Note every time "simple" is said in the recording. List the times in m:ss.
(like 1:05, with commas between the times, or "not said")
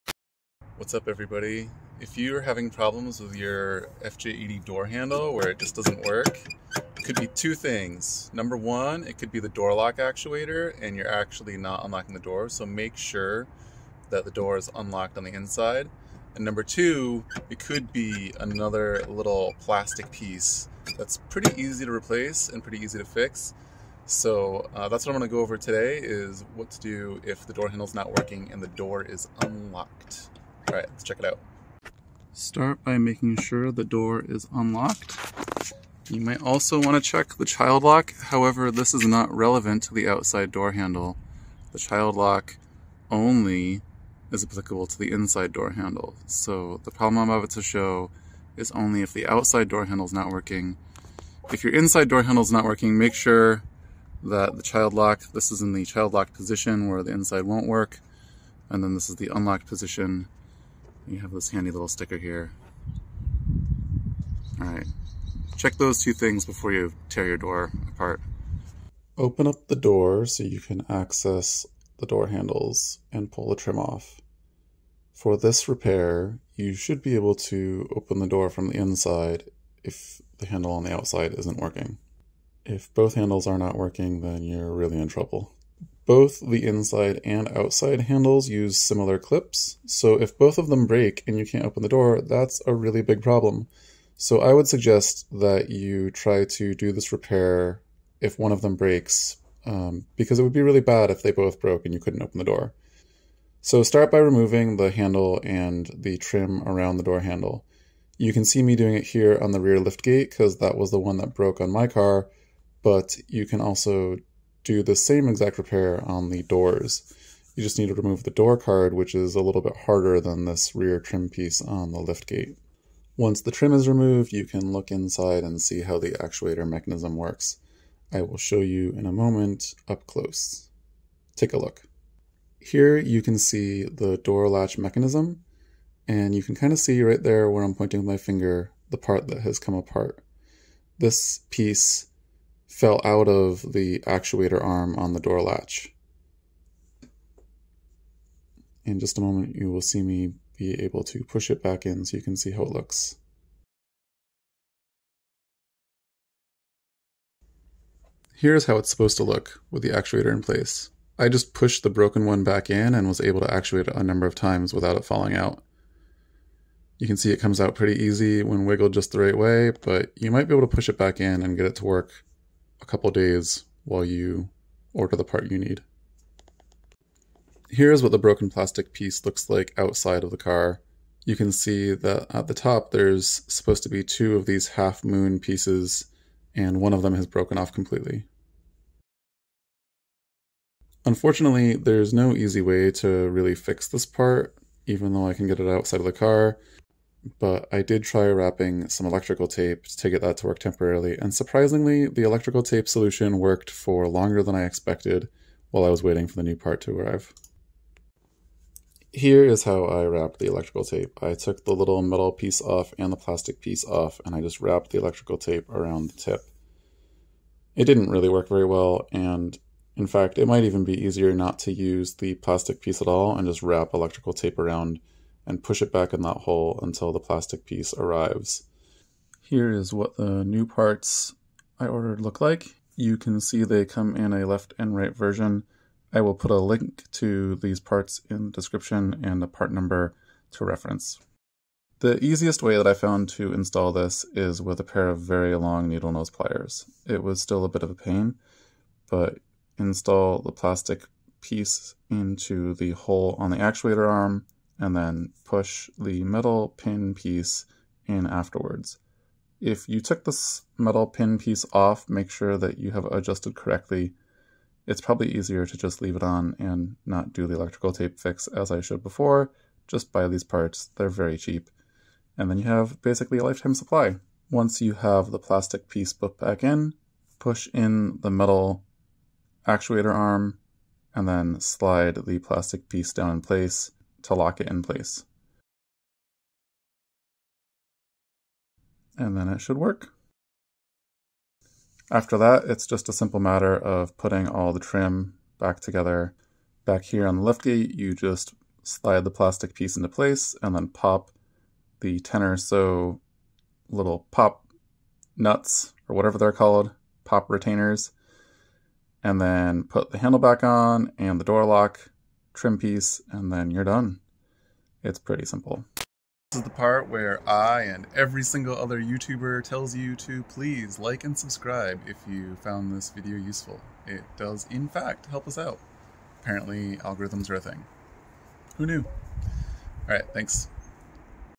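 4:53, 5:15.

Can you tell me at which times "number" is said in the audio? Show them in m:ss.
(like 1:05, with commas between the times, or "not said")
0:08, 0:16, 2:44, 3:59.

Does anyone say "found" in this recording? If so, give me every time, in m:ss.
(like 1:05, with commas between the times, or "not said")
4:02, 5:22.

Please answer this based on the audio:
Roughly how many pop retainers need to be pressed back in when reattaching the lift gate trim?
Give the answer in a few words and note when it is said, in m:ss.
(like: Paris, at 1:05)
10, at 5:02.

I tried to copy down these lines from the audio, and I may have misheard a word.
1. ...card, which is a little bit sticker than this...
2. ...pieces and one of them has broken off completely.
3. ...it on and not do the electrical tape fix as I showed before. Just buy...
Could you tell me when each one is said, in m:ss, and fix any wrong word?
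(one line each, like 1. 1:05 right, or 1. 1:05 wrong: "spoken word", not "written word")
1. 1:58 wrong: "harder", not "sticker"
2. 3:05 right
3. 4:26 right.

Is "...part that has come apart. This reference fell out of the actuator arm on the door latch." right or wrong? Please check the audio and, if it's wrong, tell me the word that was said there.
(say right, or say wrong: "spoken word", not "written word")
wrong: "piece", not "reference".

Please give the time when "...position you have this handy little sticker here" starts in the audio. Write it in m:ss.
0:59.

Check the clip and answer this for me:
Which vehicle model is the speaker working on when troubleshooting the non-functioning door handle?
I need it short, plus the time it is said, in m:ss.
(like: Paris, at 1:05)
FJ80, at 0:04.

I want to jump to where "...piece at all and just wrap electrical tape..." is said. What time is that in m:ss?
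3:42.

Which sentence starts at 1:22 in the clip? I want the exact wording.
If both handles are not working, then you're really in trouble.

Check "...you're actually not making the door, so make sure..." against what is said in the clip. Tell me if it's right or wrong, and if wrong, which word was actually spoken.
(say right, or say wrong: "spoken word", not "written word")
wrong: "unlocking", not "making".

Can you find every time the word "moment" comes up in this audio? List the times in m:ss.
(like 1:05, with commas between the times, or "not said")
2:09, 2:29.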